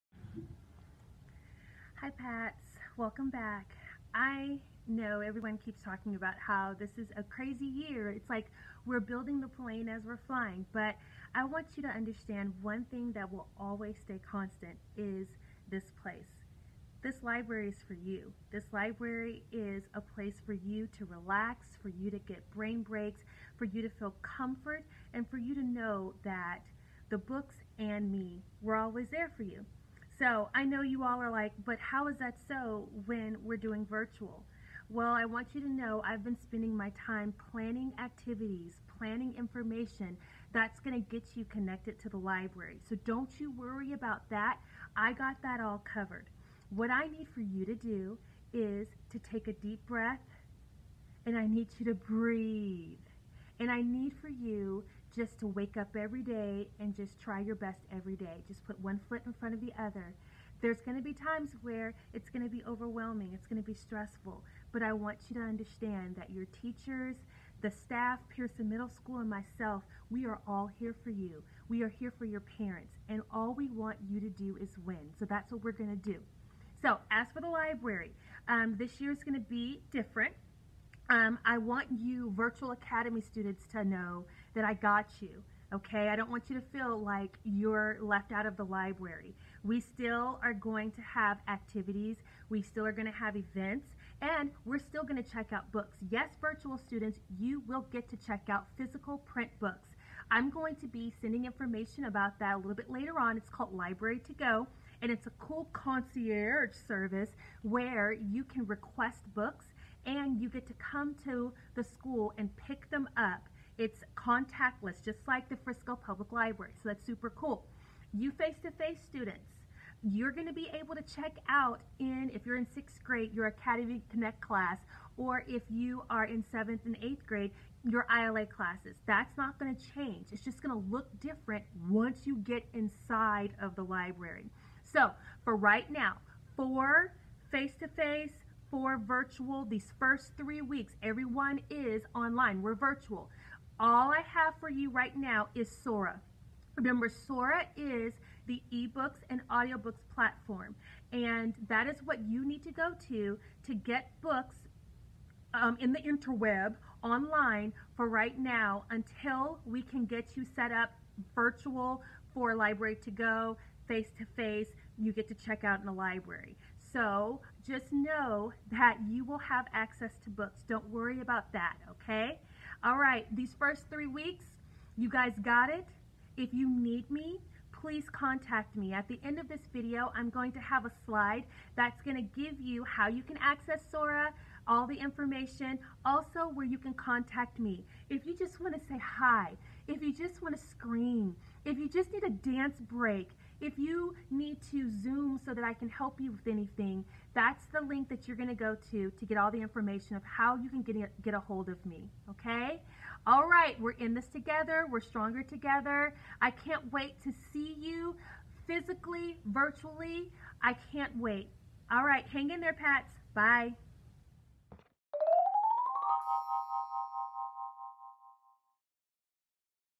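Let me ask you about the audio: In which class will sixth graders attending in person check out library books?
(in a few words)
Academy Connect.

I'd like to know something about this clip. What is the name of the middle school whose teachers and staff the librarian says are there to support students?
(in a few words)
Pearson Middle School.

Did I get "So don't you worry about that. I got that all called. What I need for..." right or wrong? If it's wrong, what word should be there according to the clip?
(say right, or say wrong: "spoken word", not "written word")
wrong: "covered", not "called".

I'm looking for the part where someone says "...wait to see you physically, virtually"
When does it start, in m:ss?
3:26.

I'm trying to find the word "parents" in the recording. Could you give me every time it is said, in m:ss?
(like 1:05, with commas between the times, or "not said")
1:12.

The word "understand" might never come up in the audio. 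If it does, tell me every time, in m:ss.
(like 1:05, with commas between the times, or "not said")
0:11, 1:05.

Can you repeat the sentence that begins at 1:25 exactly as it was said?
Okay, I don't want you to feel like you're left out of the library.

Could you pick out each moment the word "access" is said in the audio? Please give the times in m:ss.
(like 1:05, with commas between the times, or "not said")
2:49, 3:03.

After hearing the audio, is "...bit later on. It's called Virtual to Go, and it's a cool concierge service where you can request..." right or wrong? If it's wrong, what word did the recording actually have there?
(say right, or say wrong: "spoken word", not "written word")
wrong: "Library", not "Virtual".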